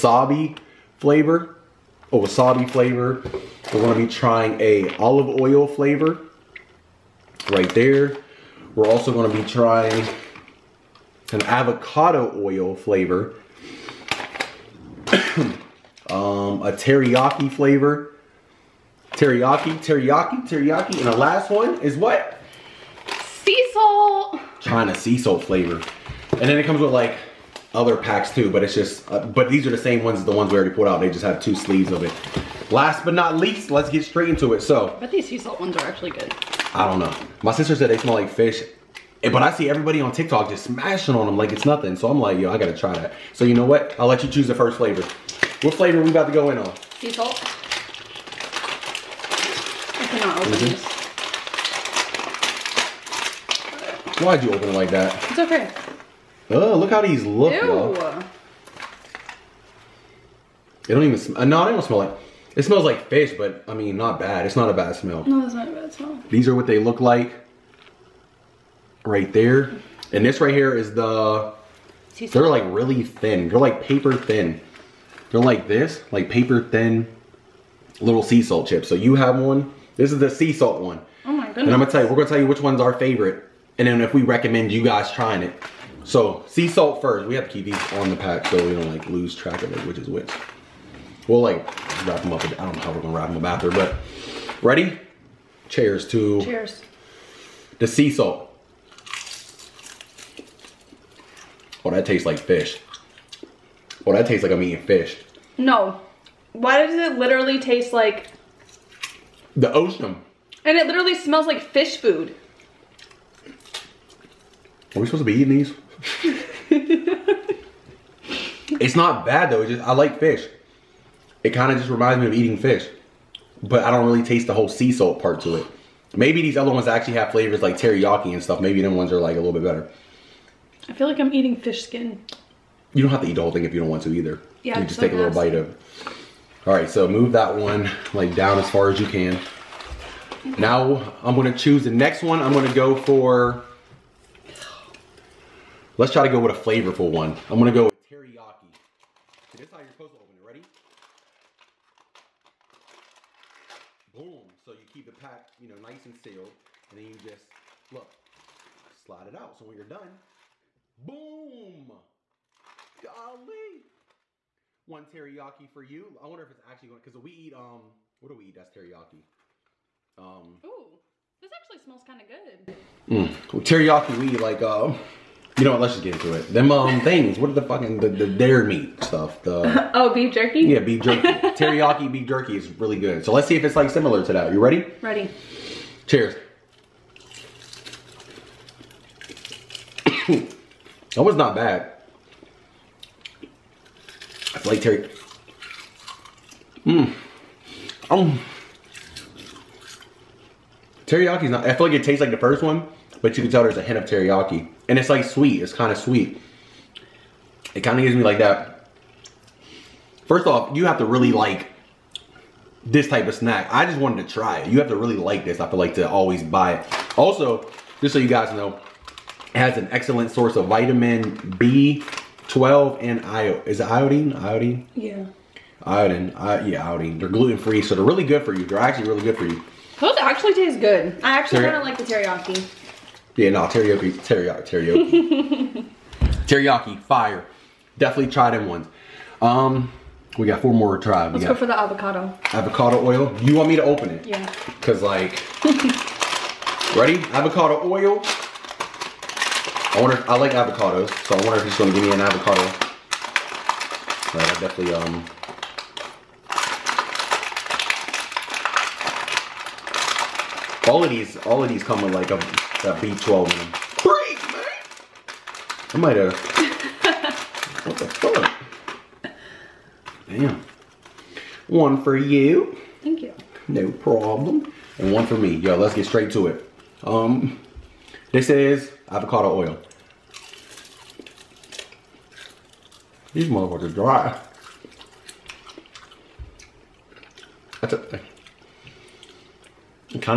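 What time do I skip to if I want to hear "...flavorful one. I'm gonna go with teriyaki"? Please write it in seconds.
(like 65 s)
146 s.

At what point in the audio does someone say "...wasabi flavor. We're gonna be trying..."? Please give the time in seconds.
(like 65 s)
2 s.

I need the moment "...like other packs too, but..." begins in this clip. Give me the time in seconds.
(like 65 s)
26 s.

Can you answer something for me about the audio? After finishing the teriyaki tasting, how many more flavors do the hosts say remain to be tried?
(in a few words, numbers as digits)
4.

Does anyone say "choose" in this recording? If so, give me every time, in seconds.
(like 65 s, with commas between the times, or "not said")
44 s, 141 s.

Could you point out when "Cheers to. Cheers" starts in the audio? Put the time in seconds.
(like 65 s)
95 s.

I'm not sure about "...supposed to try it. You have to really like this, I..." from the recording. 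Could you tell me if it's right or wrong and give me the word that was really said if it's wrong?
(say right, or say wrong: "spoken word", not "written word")
wrong: "wanted", not "supposed".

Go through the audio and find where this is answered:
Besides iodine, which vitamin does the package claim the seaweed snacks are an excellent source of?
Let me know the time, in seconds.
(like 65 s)
220 s.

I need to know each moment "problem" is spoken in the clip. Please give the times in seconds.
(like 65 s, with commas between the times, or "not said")
273 s.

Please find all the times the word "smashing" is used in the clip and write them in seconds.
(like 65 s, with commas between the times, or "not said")
40 s.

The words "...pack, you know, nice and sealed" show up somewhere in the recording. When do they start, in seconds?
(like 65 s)
155 s.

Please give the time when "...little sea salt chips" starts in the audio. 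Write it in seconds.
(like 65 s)
78 s.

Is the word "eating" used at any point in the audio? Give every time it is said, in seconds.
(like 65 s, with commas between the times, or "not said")
104 s, 115 s, 122 s, 131 s.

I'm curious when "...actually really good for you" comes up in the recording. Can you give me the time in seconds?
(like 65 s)
228 s.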